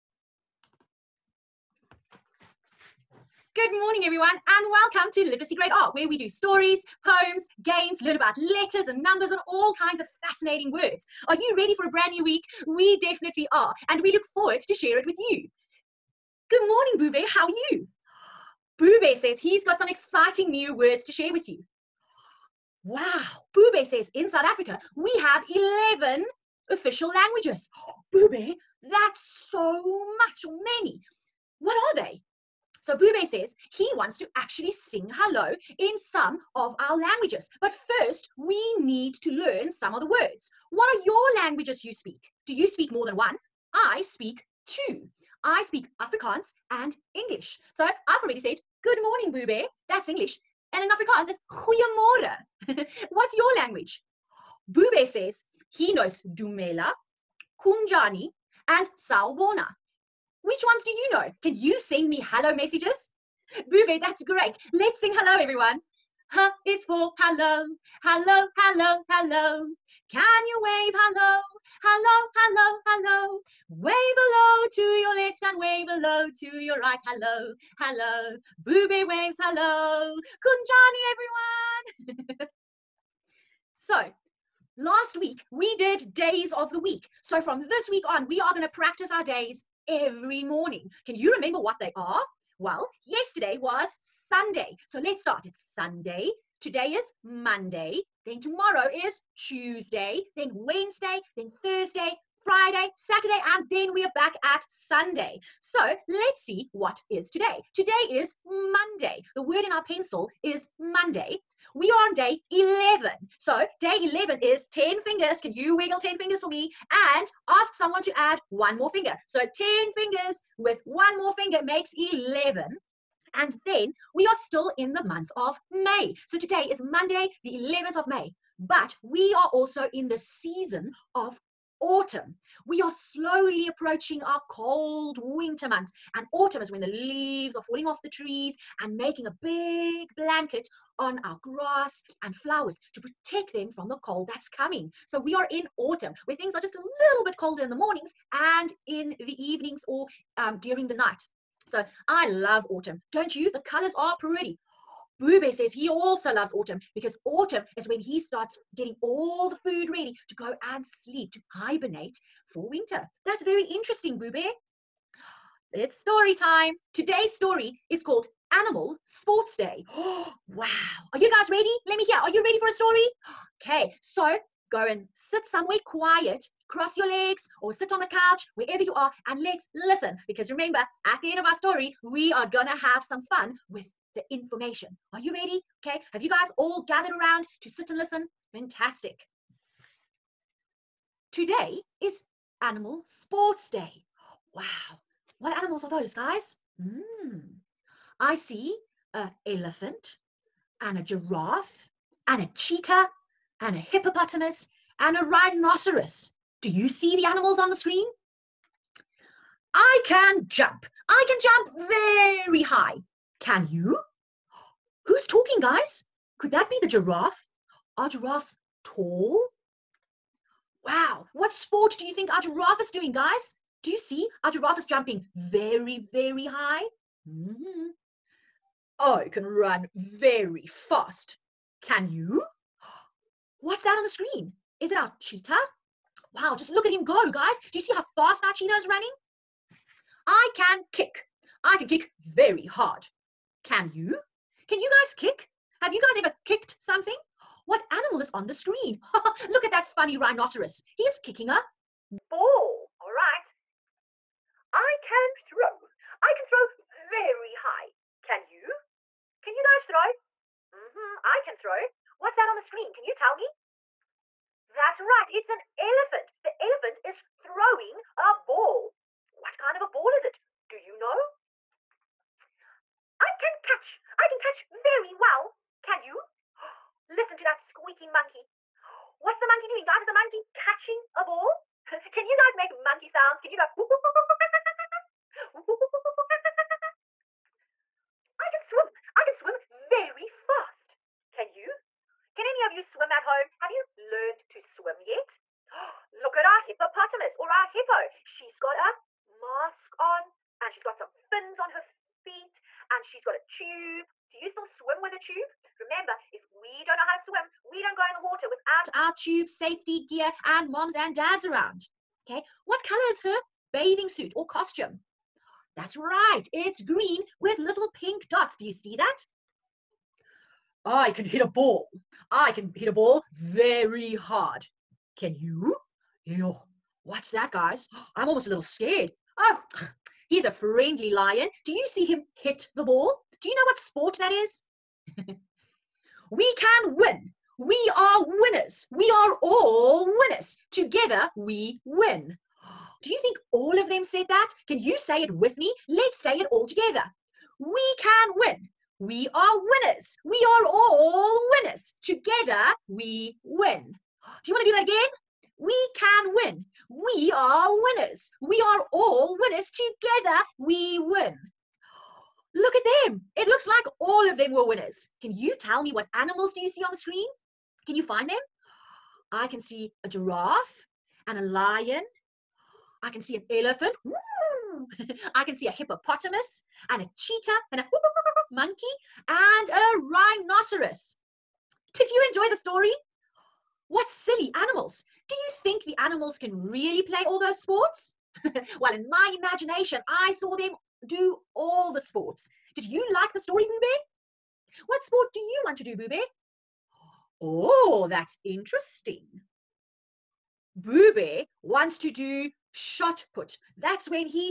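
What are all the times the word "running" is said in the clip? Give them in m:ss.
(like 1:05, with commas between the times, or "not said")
3:58.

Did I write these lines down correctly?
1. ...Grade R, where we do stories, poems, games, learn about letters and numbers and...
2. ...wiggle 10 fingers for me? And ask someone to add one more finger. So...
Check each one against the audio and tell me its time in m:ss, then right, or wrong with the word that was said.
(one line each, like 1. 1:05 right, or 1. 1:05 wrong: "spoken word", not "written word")
1. 0:05 right
2. 1:55 right.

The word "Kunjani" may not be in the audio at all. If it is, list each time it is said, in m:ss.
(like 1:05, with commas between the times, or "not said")
0:57, 1:22.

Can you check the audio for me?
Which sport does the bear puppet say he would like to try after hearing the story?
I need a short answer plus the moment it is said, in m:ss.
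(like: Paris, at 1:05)
shot put, at 6:42.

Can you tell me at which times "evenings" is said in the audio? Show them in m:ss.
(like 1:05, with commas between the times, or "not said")
2:29.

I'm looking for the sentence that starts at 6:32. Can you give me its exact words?
Did you like the story, Boo Bear?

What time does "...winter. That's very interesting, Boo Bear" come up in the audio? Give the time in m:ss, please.
2:42.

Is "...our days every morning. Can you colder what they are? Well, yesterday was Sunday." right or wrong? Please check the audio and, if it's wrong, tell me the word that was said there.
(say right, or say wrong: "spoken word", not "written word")
wrong: "remember", not "colder".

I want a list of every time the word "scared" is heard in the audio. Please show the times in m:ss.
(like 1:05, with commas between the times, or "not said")
5:28.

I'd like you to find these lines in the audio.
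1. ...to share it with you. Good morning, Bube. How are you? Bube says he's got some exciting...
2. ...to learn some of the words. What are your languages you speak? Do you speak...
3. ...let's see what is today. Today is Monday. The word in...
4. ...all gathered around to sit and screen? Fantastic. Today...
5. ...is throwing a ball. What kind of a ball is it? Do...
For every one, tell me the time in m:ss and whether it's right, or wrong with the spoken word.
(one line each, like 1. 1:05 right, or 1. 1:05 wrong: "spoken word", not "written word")
1. 0:14 right
2. 0:39 right
3. 1:46 right
4. 3:06 wrong: "listen", not "screen"
5. 4:27 right.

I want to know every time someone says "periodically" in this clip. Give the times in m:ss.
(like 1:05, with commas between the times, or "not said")
not said.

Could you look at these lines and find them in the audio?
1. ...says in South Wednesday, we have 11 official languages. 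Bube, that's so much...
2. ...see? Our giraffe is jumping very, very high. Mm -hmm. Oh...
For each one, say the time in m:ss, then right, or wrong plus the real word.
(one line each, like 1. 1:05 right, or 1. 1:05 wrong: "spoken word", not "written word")
1. 0:23 wrong: "Africa", not "Wednesday"
2. 3:43 right.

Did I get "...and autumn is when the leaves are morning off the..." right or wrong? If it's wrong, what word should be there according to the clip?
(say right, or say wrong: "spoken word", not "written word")
wrong: "falling", not "morning".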